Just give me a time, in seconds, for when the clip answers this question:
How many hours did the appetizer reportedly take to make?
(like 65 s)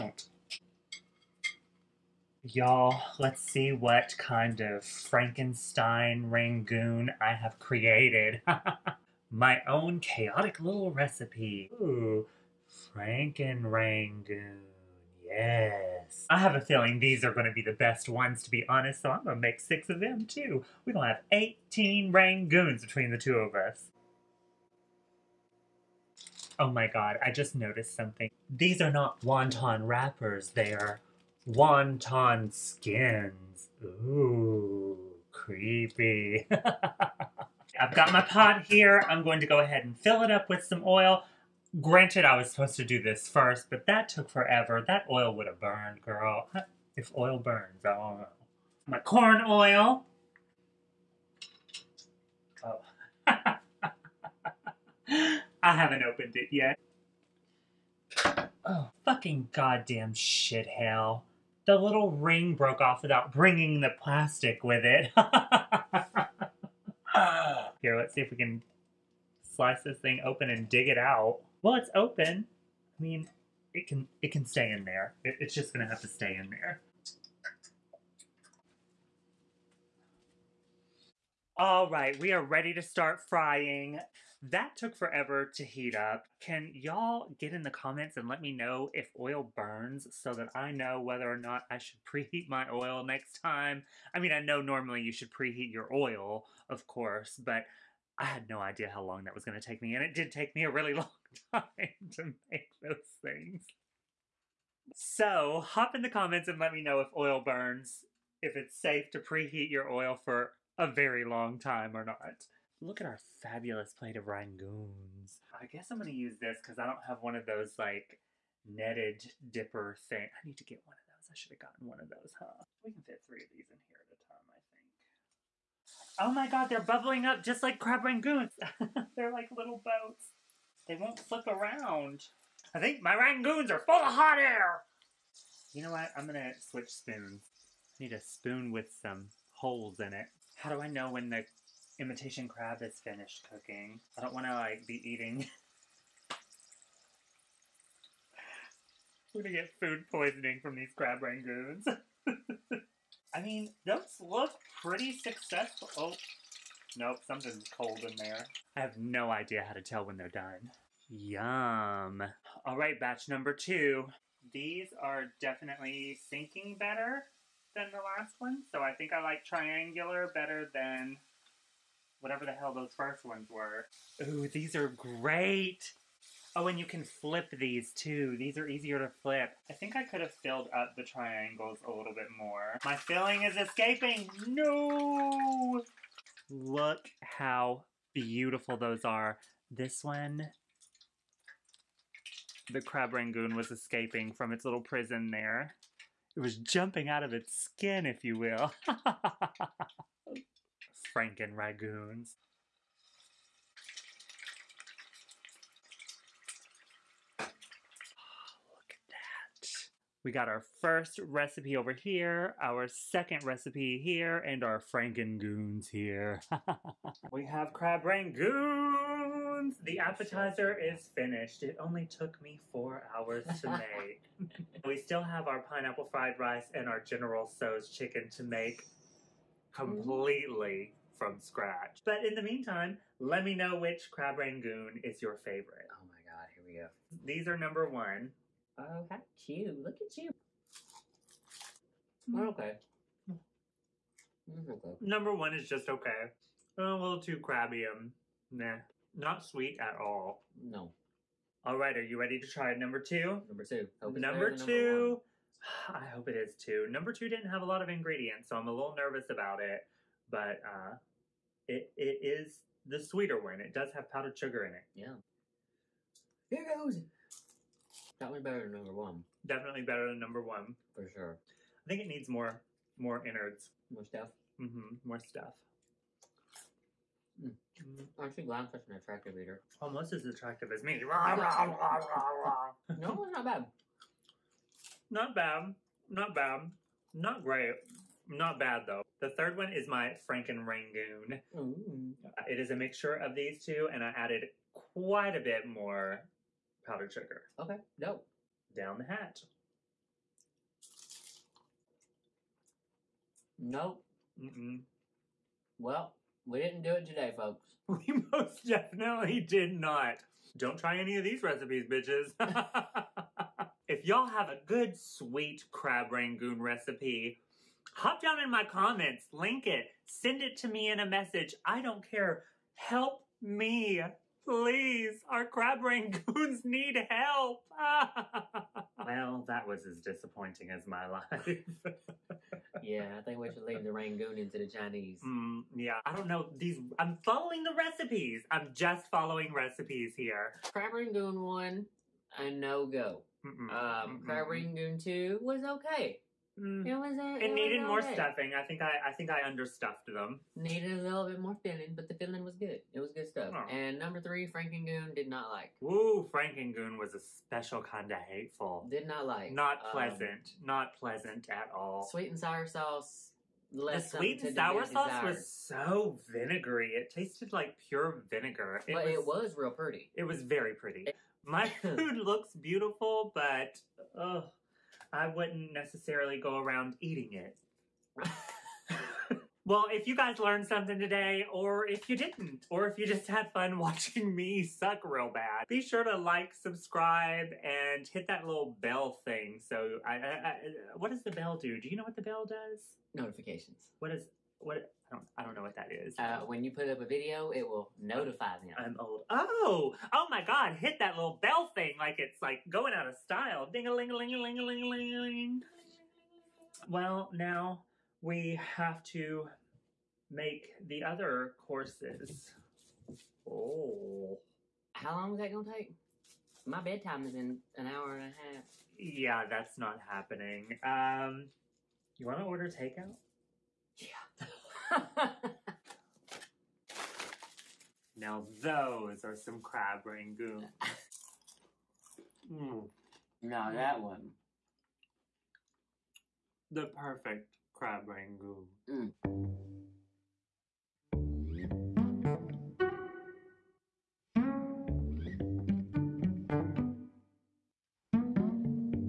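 222 s.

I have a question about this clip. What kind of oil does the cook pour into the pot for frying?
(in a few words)
corn oil.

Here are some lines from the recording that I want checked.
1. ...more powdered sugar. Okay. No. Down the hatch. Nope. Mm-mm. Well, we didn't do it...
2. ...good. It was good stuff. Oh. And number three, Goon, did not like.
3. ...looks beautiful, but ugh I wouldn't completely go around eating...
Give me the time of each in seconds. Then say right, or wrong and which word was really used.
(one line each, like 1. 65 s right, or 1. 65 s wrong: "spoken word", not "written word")
1. 295 s right
2. 352 s right
3. 372 s wrong: "necessarily", not "completely".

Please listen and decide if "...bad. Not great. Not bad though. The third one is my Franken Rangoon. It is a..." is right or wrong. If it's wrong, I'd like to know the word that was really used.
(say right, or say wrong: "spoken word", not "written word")
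right.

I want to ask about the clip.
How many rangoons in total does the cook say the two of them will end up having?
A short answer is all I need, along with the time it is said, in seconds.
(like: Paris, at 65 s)
18, at 21 s.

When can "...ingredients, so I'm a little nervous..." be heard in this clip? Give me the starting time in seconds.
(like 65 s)
257 s.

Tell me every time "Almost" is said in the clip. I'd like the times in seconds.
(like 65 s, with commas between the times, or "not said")
279 s.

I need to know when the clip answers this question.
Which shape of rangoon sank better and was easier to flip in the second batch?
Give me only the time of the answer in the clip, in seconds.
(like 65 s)
169 s.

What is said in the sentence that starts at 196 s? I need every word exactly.
It was jumping out of its skin, if you will.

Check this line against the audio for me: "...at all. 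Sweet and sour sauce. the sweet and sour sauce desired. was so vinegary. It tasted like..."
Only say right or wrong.
right.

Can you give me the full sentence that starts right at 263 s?
It does have powdered sugar in it.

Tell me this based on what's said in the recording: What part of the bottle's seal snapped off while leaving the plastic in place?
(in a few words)
the little ring.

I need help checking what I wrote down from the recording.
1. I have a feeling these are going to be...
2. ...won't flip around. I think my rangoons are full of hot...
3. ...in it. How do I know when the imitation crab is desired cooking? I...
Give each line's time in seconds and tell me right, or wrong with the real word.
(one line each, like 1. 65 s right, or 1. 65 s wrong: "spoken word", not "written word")
1. 16 s right
2. 130 s right
3. 140 s wrong: "finished", not "desired".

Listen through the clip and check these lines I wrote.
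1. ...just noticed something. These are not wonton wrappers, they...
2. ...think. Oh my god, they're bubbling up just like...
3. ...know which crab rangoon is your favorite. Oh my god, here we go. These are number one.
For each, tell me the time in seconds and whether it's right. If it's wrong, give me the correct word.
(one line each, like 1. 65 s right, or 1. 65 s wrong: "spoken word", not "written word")
1. 27 s right
2. 126 s right
3. 233 s right.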